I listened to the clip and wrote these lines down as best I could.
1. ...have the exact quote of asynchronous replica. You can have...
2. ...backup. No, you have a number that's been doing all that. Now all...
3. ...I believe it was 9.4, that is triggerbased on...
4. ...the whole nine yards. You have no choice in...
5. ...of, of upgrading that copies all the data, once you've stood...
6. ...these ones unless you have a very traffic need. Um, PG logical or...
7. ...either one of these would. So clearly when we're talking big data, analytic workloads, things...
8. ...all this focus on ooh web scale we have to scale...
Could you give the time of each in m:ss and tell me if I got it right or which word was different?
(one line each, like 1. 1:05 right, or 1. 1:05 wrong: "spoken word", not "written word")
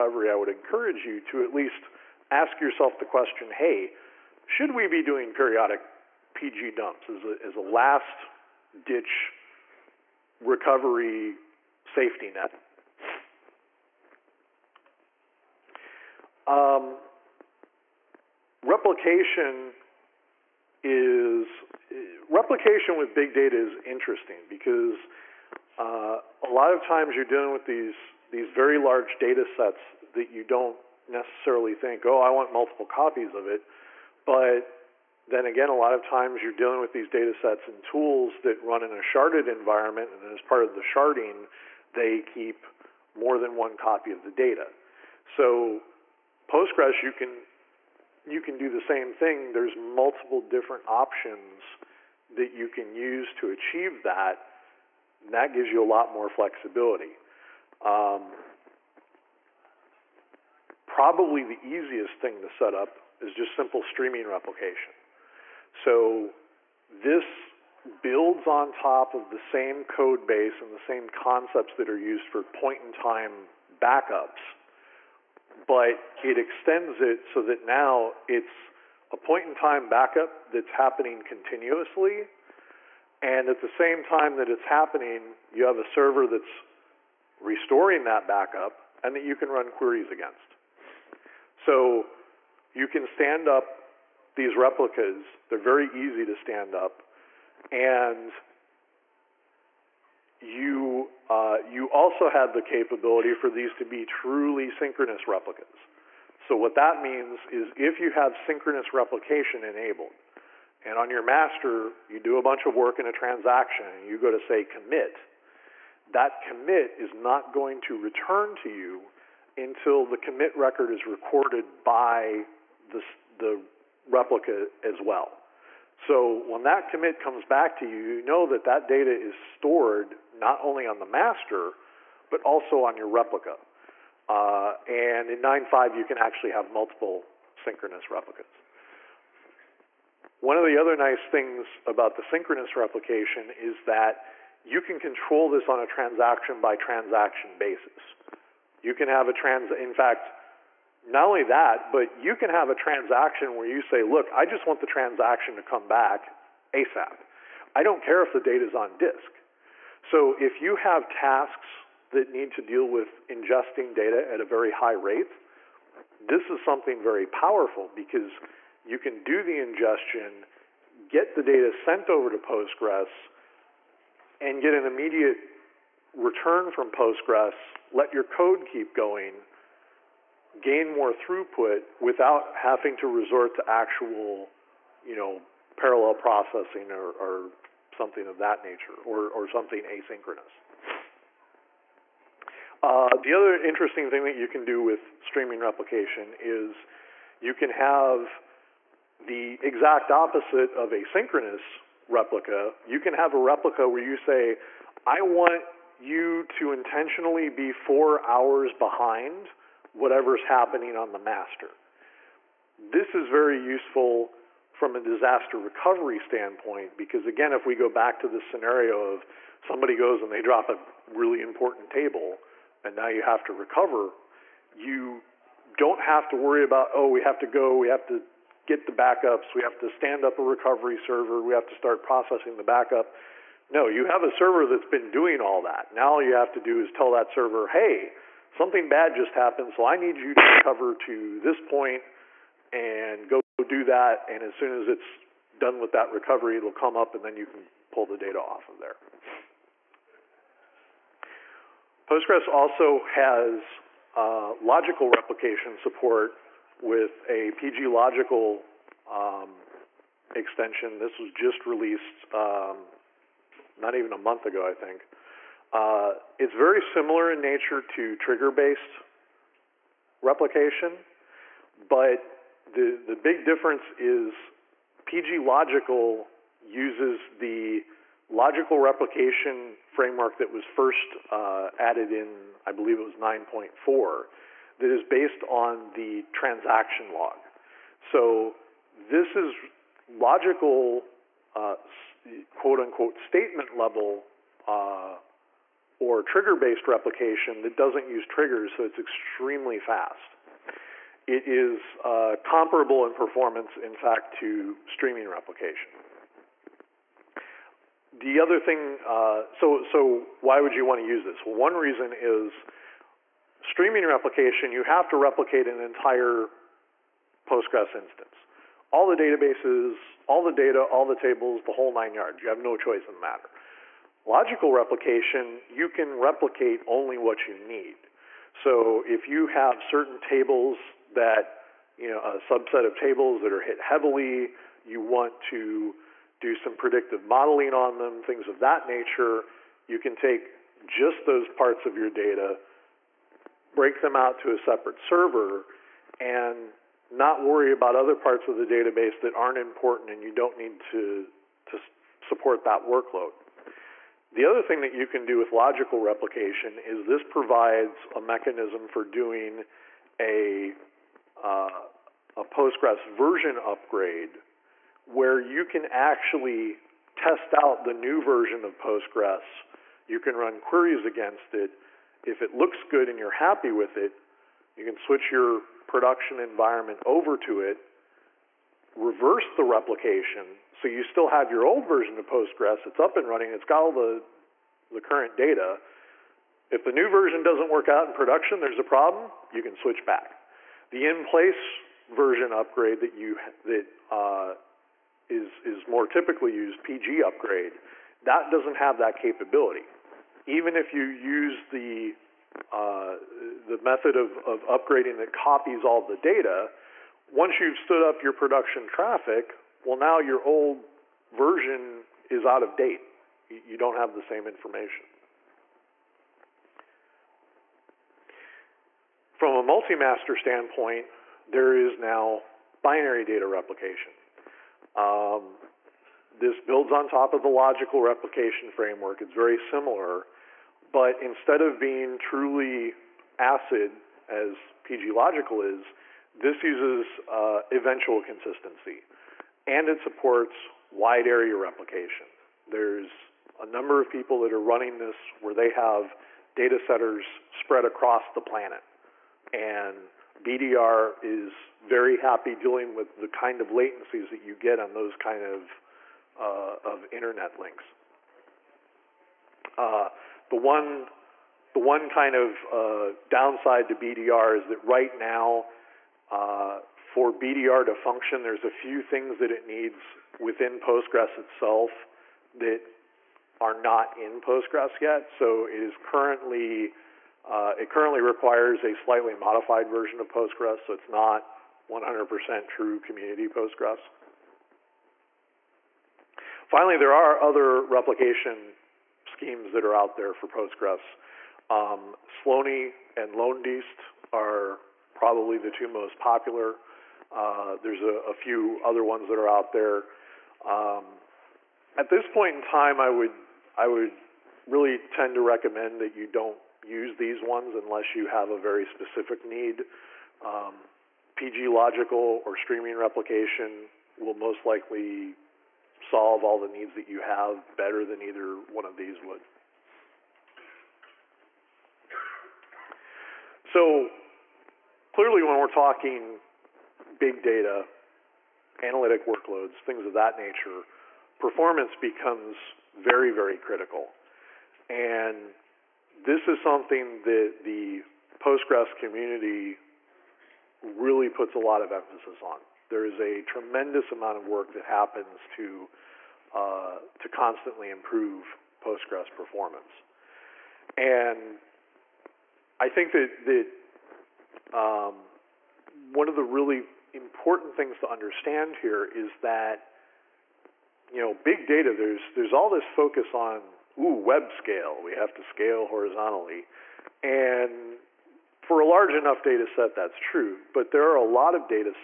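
1. 3:17 wrong: "opposite", not "quote"
2. 3:52 wrong: "server", not "number"
3. 4:42 wrong: "based", not "triggerbased"
4. 5:21 right
5. 6:44 right
6. 8:27 wrong: "specific", not "traffic"
7. 8:38 right
8. 9:22 right.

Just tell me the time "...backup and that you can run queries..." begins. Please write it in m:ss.
1:28.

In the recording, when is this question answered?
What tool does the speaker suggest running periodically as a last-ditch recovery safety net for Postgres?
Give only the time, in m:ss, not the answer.
0:06.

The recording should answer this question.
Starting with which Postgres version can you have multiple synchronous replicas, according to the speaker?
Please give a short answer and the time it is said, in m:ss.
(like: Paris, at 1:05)
9.5, at 2:15.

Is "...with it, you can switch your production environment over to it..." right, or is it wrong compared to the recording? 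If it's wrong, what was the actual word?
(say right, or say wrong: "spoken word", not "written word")
right.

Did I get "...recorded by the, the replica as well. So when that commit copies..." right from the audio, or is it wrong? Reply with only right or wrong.
wrong.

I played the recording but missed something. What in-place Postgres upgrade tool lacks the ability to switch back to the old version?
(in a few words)
PG upgrade.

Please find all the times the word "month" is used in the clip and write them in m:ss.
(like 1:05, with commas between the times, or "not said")
4:24.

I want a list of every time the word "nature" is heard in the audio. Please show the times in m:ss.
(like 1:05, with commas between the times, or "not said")
3:08, 4:27, 5:38, 8:50.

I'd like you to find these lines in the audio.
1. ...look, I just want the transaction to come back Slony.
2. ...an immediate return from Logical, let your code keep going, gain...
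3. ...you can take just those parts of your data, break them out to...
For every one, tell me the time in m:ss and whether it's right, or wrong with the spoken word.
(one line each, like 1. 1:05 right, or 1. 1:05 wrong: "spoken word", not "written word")
1. 2:34 wrong: "ASAP", not "Slony"
2. 2:54 wrong: "Postgres", not "Logical"
3. 5:39 right.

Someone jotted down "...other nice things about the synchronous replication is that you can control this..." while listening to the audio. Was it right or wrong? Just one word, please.
right.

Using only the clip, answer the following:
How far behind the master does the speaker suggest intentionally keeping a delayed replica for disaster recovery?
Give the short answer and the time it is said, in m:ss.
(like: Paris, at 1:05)
4 hours, at 3:27.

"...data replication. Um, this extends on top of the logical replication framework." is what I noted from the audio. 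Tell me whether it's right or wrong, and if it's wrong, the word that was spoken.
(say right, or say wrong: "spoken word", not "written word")
wrong: "builds", not "extends".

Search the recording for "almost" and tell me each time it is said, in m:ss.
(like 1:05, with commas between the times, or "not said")
not said.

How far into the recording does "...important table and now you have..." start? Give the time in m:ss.
3:41.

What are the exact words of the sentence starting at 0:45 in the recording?
So Postgres, you can you can do the same thing.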